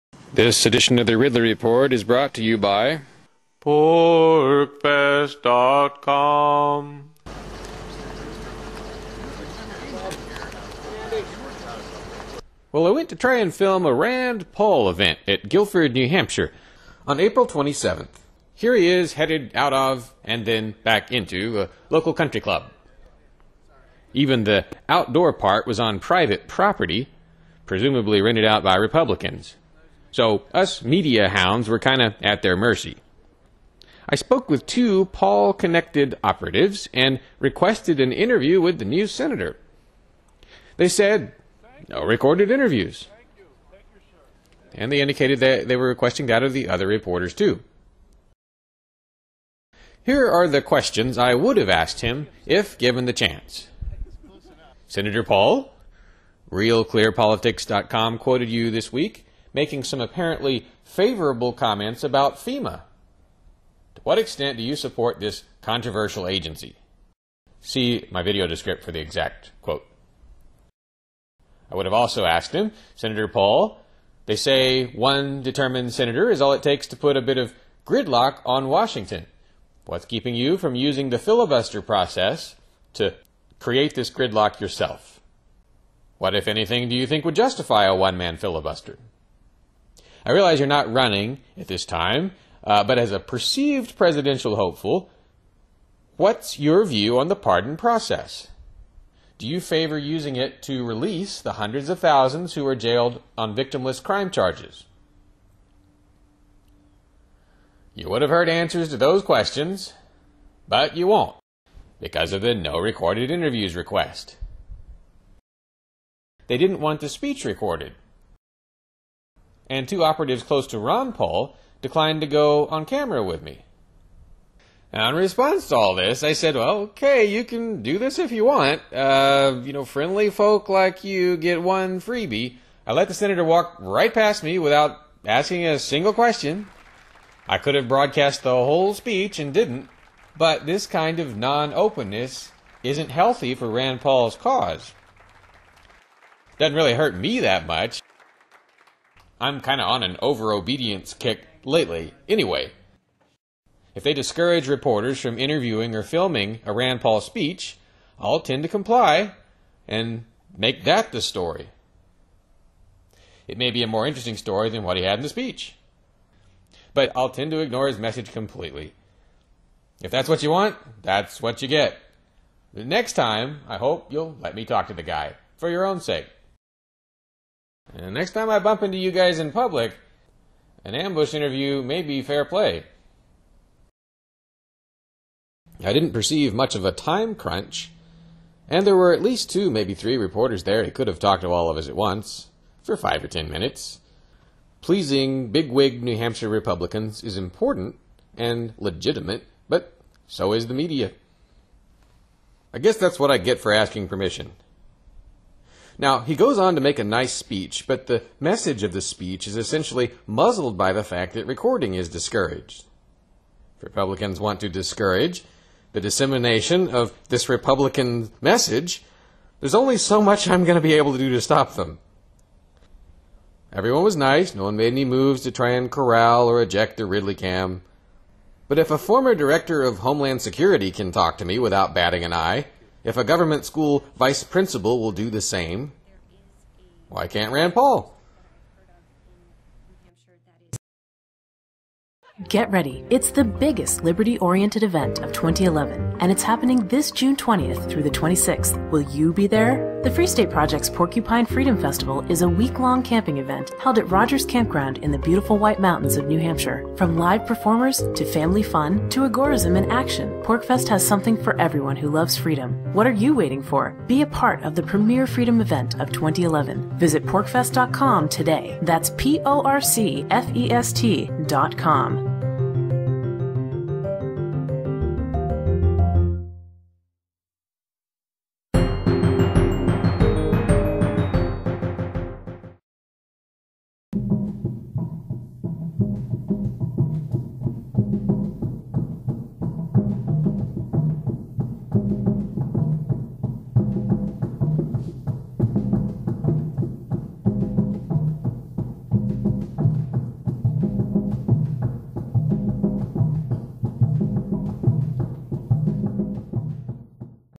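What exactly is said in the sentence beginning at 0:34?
I spoke with two Paul connected operatives and requested an interview with the new senator.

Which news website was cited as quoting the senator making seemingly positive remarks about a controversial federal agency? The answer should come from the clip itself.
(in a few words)
RealClearPolitics.com.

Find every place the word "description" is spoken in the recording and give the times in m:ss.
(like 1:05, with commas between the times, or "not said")
1:08.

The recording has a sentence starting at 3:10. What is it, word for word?
He could have talked to all of us at once for five or ten minutes.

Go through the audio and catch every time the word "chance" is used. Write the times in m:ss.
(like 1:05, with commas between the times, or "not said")
0:53.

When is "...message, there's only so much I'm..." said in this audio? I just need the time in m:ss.
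3:38.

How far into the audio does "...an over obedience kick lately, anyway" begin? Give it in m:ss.
2:30.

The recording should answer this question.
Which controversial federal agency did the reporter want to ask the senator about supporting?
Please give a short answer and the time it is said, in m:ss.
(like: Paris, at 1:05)
FEMA, at 1:02.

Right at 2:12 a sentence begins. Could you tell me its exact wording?
I let the senator walk right past me without asking a single question.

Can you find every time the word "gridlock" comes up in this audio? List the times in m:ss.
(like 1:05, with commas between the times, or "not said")
1:17, 1:24.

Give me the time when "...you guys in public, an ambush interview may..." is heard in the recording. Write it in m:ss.
2:58.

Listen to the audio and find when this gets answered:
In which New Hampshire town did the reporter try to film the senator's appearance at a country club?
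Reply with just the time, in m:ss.
0:15.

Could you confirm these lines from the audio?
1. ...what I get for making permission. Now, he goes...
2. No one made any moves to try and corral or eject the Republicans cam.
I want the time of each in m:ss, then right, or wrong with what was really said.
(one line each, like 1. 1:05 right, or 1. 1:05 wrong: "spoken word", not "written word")
1. 3:23 wrong: "asking", not "making"
2. 3:44 wrong: "Ridley", not "Republicans".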